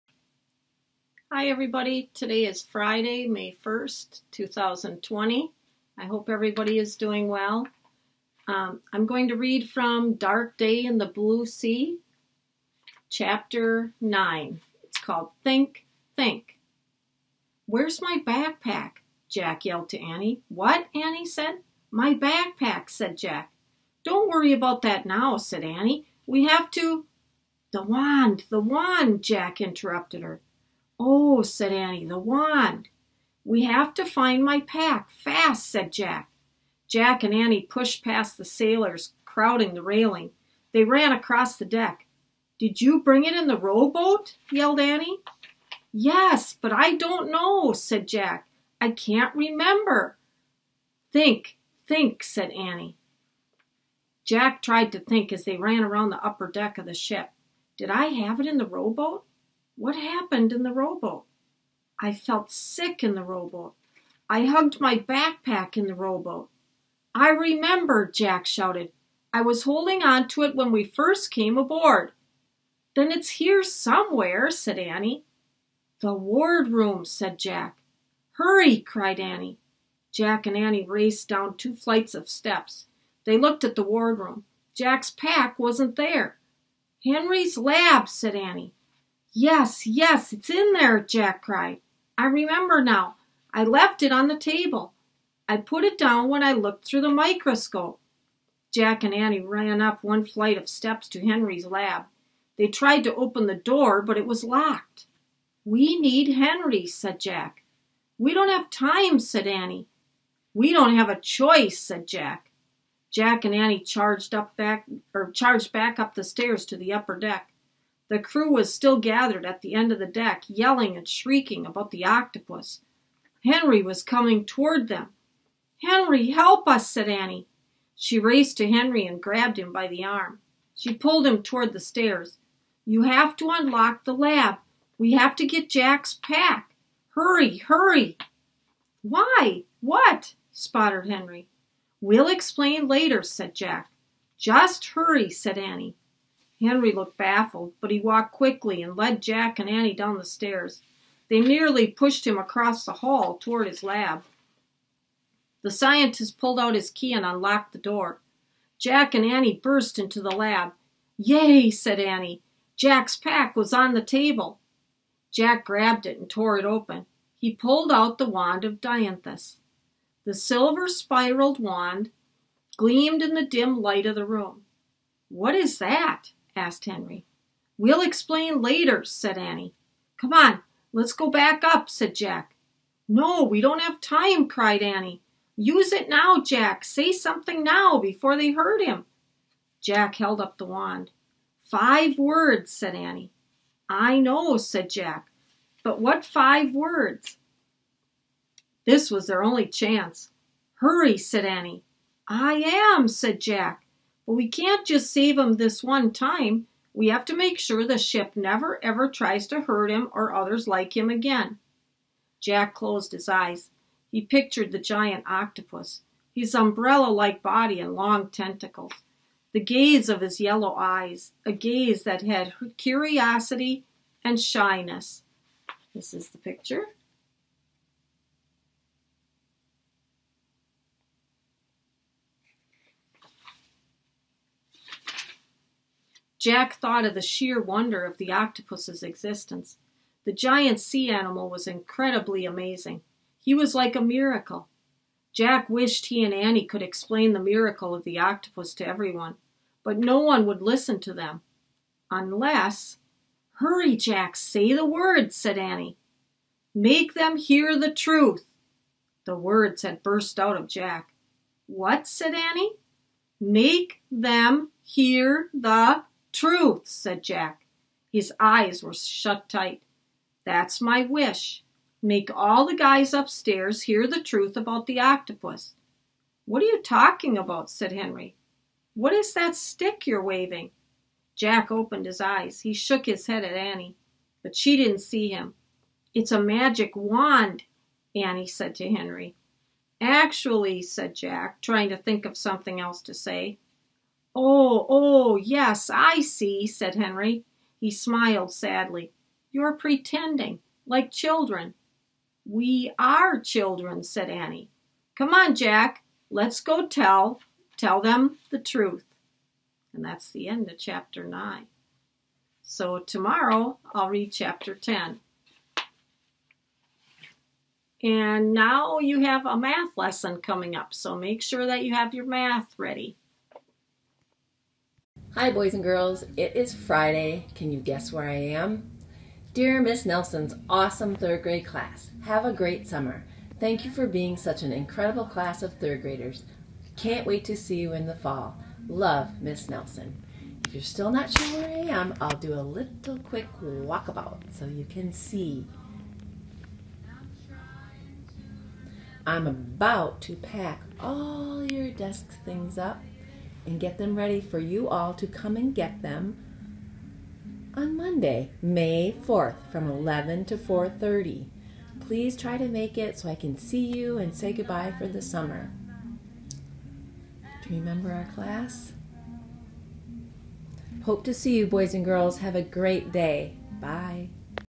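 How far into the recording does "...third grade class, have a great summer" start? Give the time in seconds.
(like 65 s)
331 s.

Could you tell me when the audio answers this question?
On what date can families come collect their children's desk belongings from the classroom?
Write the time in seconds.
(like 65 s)
357 s.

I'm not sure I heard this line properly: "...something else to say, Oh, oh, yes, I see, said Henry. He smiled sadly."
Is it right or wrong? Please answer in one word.
right.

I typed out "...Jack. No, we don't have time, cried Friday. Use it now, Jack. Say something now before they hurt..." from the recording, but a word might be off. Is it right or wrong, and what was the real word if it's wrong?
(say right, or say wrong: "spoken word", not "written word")
wrong: "Annie", not "Friday".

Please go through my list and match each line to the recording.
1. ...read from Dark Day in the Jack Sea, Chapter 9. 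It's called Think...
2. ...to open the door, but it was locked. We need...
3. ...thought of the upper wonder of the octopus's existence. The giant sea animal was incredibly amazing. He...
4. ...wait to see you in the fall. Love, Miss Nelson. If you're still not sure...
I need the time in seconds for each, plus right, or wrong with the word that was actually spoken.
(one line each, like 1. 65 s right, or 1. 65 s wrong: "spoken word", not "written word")
1. 9 s wrong: "Blue", not "Jack"
2. 103 s right
3. 236 s wrong: "sheer", not "upper"
4. 337 s right.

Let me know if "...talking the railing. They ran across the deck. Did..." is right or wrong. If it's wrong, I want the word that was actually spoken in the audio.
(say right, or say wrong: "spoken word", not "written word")
wrong: "crowding", not "talking".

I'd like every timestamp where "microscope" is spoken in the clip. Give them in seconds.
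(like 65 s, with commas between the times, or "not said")
97 s.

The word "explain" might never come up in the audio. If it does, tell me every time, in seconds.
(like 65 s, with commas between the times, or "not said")
142 s, 178 s, 246 s.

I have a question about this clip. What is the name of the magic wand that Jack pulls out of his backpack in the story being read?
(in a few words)
Wand of Dianthus.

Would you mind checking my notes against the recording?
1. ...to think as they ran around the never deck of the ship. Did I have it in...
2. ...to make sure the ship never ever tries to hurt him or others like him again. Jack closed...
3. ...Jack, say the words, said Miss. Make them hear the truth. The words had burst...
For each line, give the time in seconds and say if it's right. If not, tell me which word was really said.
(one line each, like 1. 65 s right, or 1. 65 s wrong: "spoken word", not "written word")
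1. 54 s wrong: "upper", not "never"
2. 207 s right
3. 253 s wrong: "Annie", not "Miss".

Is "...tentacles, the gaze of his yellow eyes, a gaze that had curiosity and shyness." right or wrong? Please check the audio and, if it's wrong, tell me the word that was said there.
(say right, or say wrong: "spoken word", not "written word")
right.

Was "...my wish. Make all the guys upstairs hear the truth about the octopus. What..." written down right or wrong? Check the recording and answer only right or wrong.
right.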